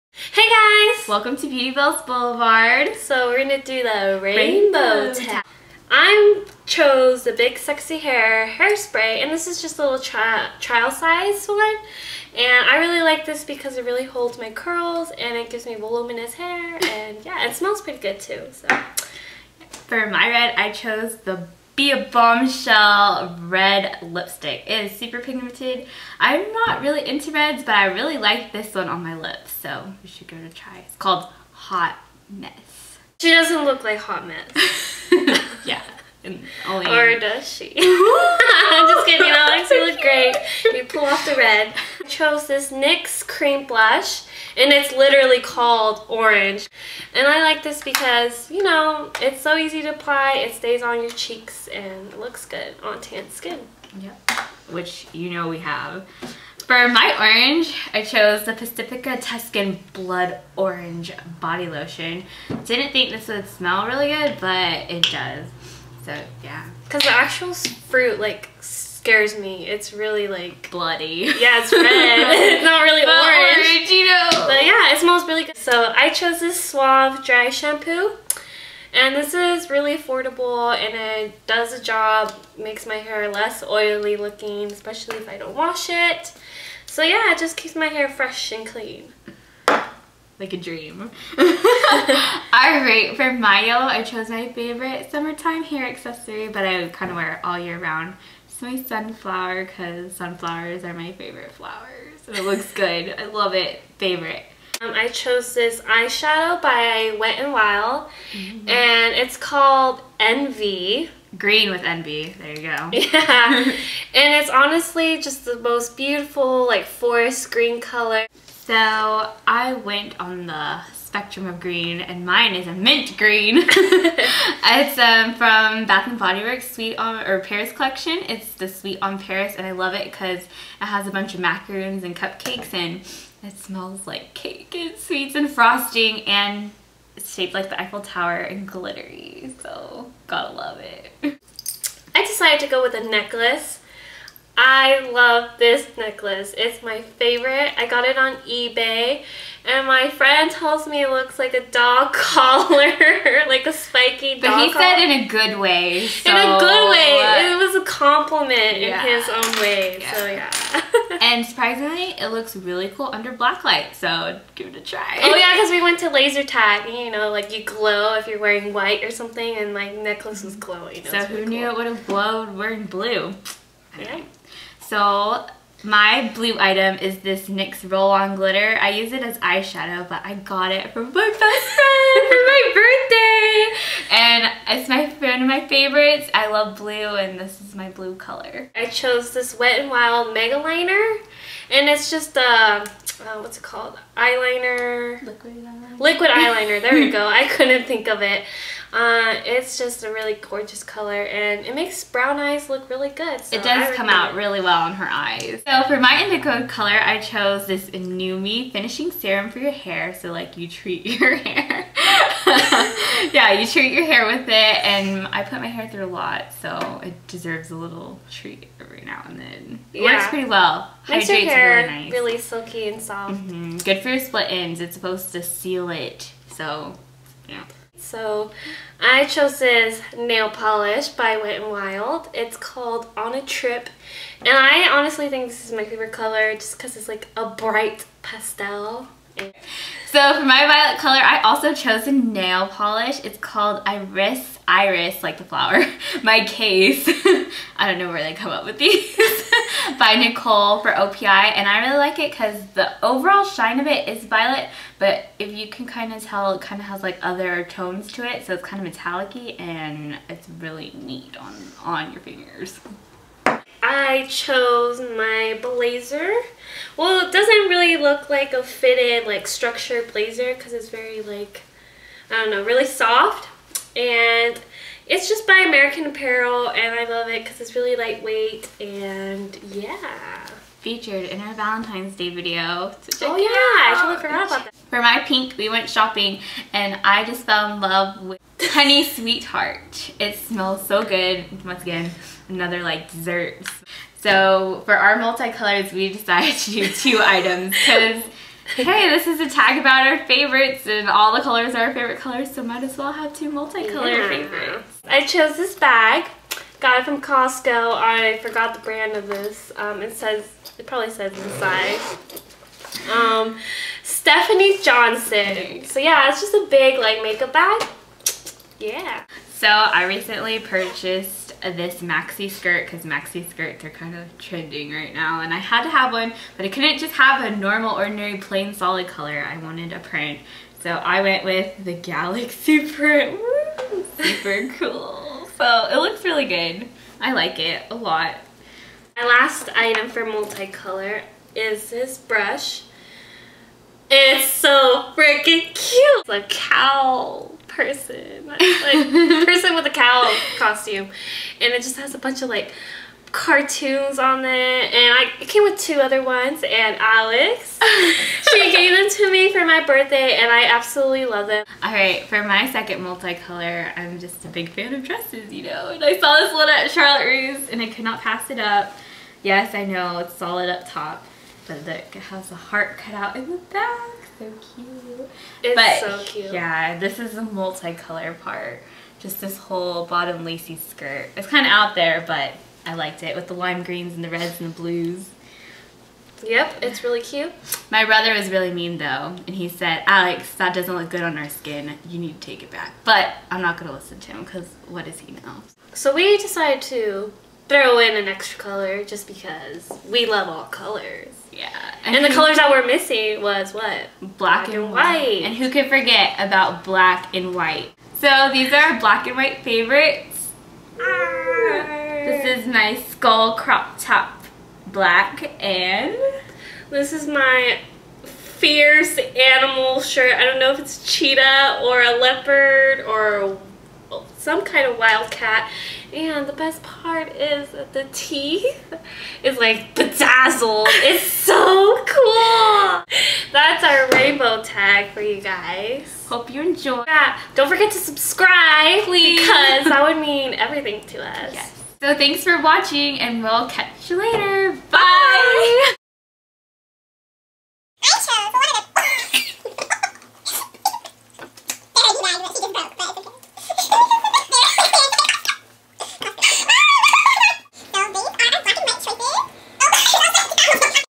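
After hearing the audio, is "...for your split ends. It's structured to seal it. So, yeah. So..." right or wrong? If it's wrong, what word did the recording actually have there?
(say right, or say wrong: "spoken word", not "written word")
wrong: "supposed", not "structured".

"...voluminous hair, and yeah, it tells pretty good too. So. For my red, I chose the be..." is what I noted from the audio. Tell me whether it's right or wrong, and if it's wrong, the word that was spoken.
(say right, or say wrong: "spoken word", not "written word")
wrong: "smells", not "tells".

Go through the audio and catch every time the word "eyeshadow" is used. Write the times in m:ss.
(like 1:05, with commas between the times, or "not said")
1:45, 2:59.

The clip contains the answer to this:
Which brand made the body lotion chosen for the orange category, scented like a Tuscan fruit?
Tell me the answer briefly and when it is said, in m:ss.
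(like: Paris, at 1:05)
Pacifica, at 0:58.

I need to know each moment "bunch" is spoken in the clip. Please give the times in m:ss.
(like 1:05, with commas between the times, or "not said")
2:11, 5:52.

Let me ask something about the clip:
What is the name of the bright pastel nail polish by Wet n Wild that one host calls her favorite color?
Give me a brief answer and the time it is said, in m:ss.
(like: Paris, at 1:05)
On a Trip, at 3:53.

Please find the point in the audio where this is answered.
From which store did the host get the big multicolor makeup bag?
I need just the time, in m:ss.
5:07.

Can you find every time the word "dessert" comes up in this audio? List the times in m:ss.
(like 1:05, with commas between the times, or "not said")
4:53.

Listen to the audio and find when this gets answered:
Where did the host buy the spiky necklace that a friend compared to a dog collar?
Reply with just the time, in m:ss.
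2:28.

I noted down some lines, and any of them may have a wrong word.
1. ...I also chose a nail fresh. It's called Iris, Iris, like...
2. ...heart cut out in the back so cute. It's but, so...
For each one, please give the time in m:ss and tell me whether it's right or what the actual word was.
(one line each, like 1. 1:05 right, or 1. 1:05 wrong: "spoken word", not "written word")
1. 4:01 wrong: "polish", not "fresh"
2. 6:12 right.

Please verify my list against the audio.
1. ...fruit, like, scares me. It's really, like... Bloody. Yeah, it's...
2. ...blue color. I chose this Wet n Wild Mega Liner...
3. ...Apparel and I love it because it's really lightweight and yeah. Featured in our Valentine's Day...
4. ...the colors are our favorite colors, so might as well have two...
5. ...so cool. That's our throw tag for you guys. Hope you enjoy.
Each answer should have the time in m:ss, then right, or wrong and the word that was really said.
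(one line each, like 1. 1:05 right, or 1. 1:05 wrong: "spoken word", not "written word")
1. 1:07 right
2. 3:07 right
3. 4:36 right
4. 5:01 right
5. 7:11 wrong: "rainbow", not "throw".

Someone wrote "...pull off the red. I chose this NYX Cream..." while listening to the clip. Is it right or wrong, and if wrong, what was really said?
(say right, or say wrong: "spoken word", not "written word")
right.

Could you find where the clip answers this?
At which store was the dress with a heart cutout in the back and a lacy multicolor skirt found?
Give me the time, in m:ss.
6:06.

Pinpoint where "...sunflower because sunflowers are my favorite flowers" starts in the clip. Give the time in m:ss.
1:38.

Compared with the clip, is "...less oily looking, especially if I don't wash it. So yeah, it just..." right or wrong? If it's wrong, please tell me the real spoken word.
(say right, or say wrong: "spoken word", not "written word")
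right.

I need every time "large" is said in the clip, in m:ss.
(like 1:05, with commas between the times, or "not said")
not said.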